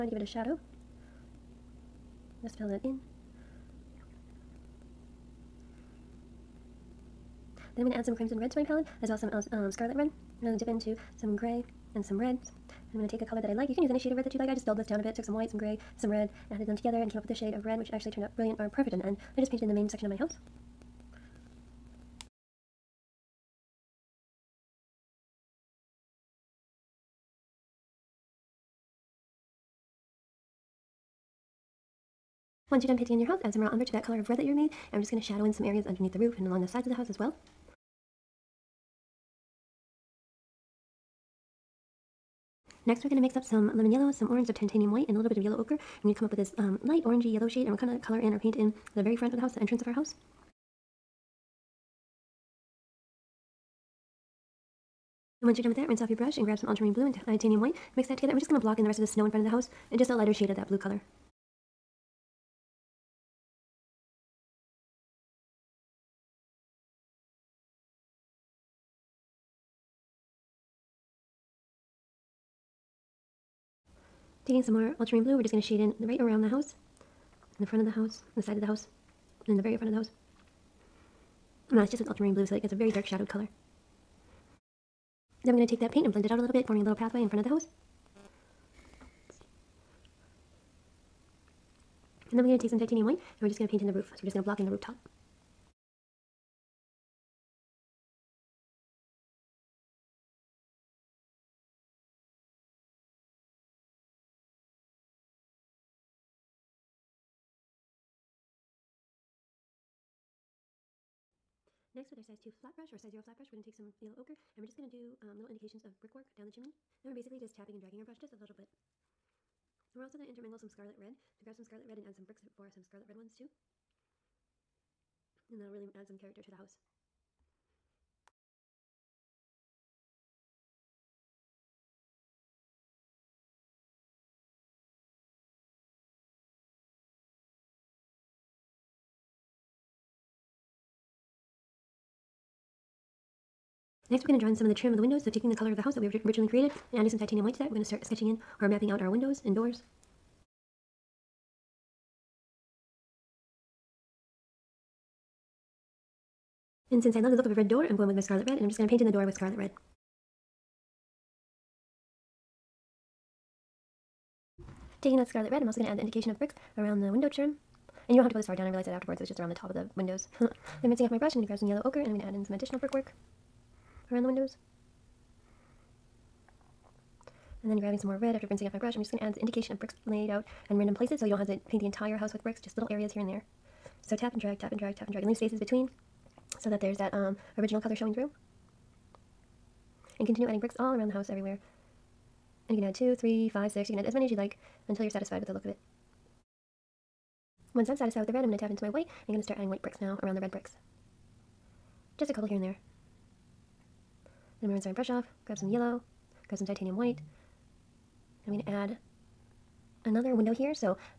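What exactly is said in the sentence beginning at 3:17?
Once I'm satisfied with the red, I'm going to tap into my white.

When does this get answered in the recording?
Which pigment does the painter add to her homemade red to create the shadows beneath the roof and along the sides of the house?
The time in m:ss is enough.
0:33.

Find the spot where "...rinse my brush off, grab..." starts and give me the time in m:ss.
3:24.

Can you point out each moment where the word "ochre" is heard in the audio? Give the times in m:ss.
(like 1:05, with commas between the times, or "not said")
0:45, 1:54, 2:51.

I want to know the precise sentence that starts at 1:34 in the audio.
So we're just going to block in the rooftop.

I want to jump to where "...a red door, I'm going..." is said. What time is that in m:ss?
2:37.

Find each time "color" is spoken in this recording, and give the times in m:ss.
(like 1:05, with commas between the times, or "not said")
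0:13, 0:34, 0:48, 1:00, 1:23, 2:25, 3:07.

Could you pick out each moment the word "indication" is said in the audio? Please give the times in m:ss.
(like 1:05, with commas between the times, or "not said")
1:55, 2:46, 2:59.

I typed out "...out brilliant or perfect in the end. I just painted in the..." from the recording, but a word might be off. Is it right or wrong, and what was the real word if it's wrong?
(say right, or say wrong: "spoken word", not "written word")
right.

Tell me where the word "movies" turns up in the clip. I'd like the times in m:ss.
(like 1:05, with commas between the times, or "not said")
not said.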